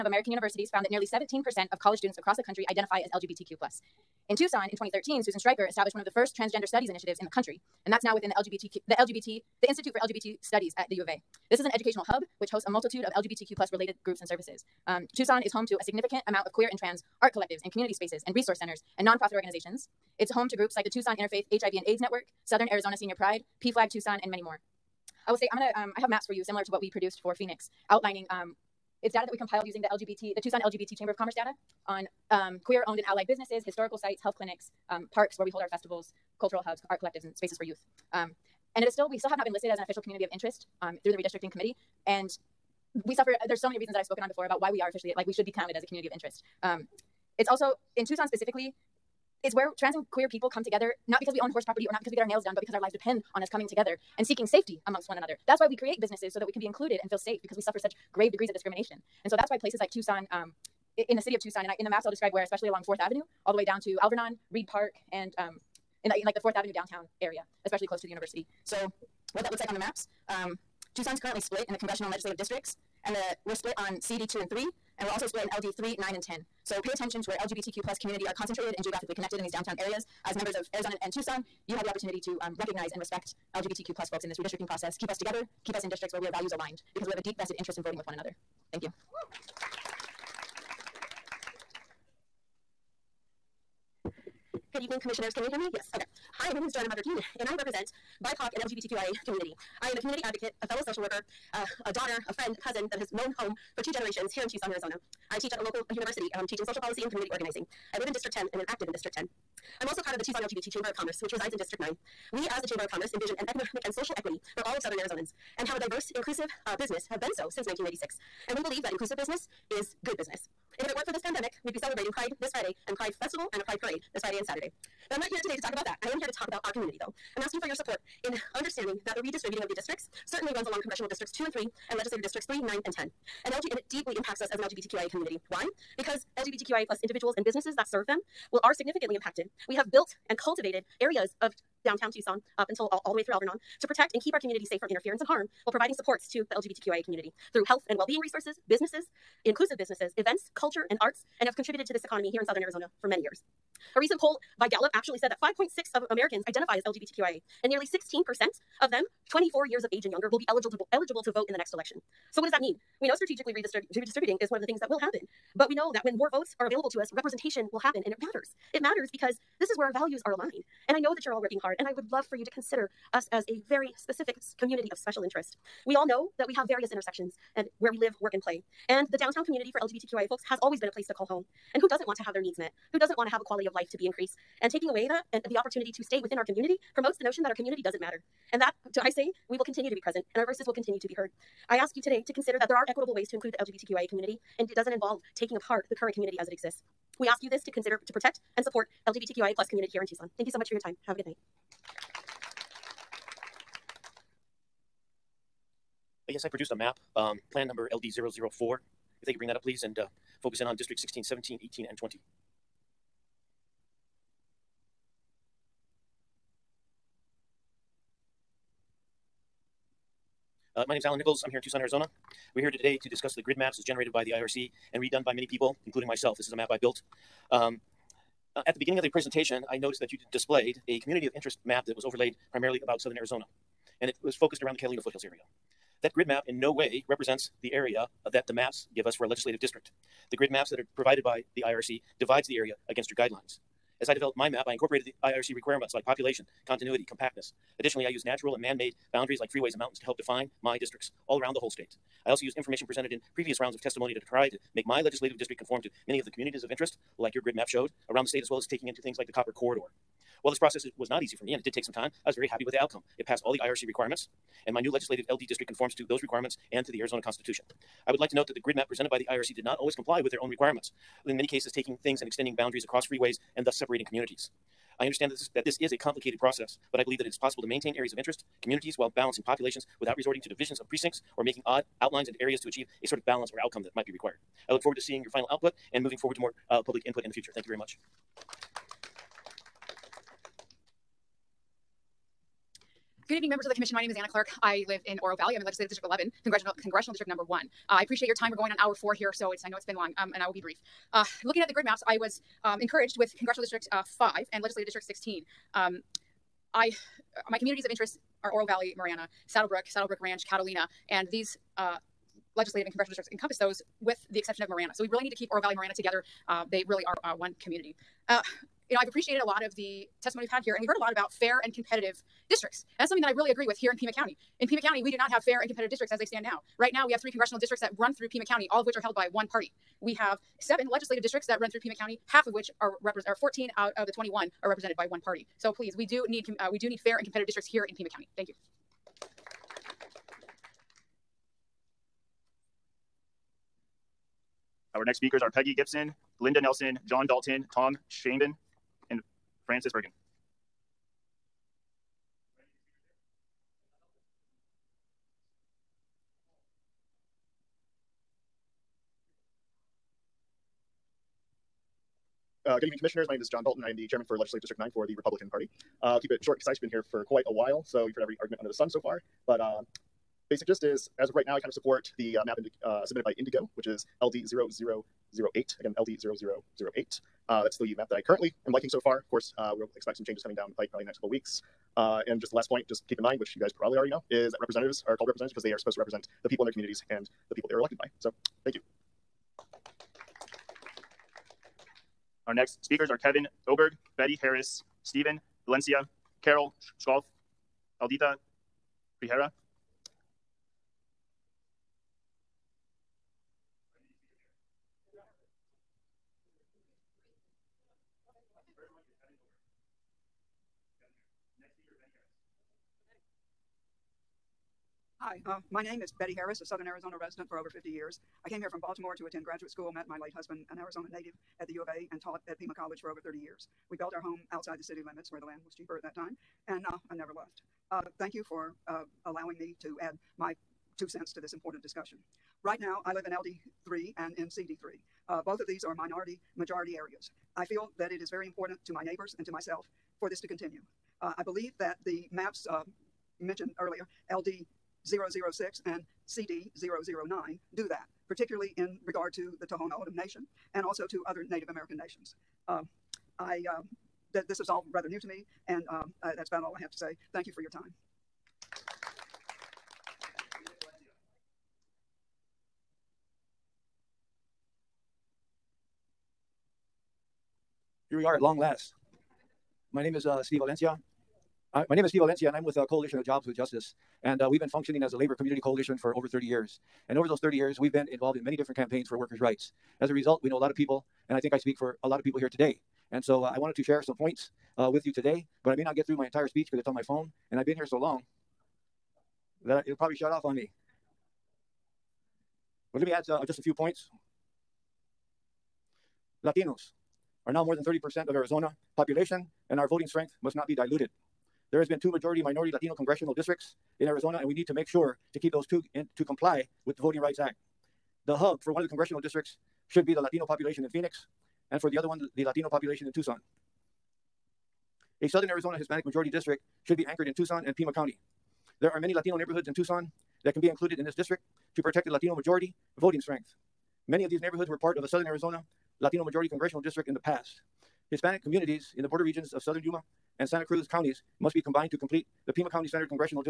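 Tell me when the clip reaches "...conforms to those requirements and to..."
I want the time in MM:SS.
04:25.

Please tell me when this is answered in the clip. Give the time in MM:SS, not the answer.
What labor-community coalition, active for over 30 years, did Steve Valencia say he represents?
07:52.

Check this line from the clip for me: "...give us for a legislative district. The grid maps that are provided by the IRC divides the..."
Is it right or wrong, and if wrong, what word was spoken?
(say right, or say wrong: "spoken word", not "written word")
right.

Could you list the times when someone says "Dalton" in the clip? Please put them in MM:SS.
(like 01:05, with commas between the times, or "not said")
05:47, 06:03.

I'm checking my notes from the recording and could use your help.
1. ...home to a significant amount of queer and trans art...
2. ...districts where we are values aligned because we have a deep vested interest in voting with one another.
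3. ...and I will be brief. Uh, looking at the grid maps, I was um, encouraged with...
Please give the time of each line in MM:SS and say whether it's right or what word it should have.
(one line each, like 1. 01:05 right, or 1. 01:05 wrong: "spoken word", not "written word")
1. 00:15 right
2. 01:25 right
3. 05:00 right.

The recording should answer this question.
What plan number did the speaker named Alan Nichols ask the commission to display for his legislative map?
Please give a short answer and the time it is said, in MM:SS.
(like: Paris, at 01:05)
LD004, at 03:27.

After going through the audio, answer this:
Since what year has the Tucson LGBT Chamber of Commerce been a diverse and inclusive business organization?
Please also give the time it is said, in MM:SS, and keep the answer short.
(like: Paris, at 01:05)
1996, at 01:57.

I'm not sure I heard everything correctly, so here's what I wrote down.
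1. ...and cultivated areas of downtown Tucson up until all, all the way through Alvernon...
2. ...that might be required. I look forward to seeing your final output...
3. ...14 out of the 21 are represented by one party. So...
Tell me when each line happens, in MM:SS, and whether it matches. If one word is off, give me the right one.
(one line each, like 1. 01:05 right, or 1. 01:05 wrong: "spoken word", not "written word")
1. 02:20 right
2. 04:43 right
3. 05:33 right.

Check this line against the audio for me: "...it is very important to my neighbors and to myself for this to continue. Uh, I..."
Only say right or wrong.
right.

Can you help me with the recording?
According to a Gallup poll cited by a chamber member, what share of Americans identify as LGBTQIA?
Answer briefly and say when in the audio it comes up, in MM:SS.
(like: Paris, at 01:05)
5.6, at 02:35.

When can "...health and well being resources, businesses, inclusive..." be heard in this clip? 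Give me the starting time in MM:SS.
02:27.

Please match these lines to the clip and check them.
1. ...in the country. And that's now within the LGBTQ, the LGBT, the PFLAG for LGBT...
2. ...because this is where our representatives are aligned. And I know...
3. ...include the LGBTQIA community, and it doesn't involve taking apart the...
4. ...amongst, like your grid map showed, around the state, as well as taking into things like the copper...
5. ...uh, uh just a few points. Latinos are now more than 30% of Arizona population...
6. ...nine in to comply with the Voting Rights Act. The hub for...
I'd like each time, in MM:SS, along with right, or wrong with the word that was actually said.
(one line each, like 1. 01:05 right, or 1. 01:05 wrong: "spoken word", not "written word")
1. 00:07 wrong: "Institute", not "PFLAG"
2. 02:49 wrong: "values", not "representatives"
3. 03:13 right
4. 04:16 wrong: "interest", not "amongst"
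5. 08:13 right
6. 08:25 wrong: "two", not "nine".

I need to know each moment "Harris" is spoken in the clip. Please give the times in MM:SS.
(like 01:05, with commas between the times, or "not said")
06:34, 06:56.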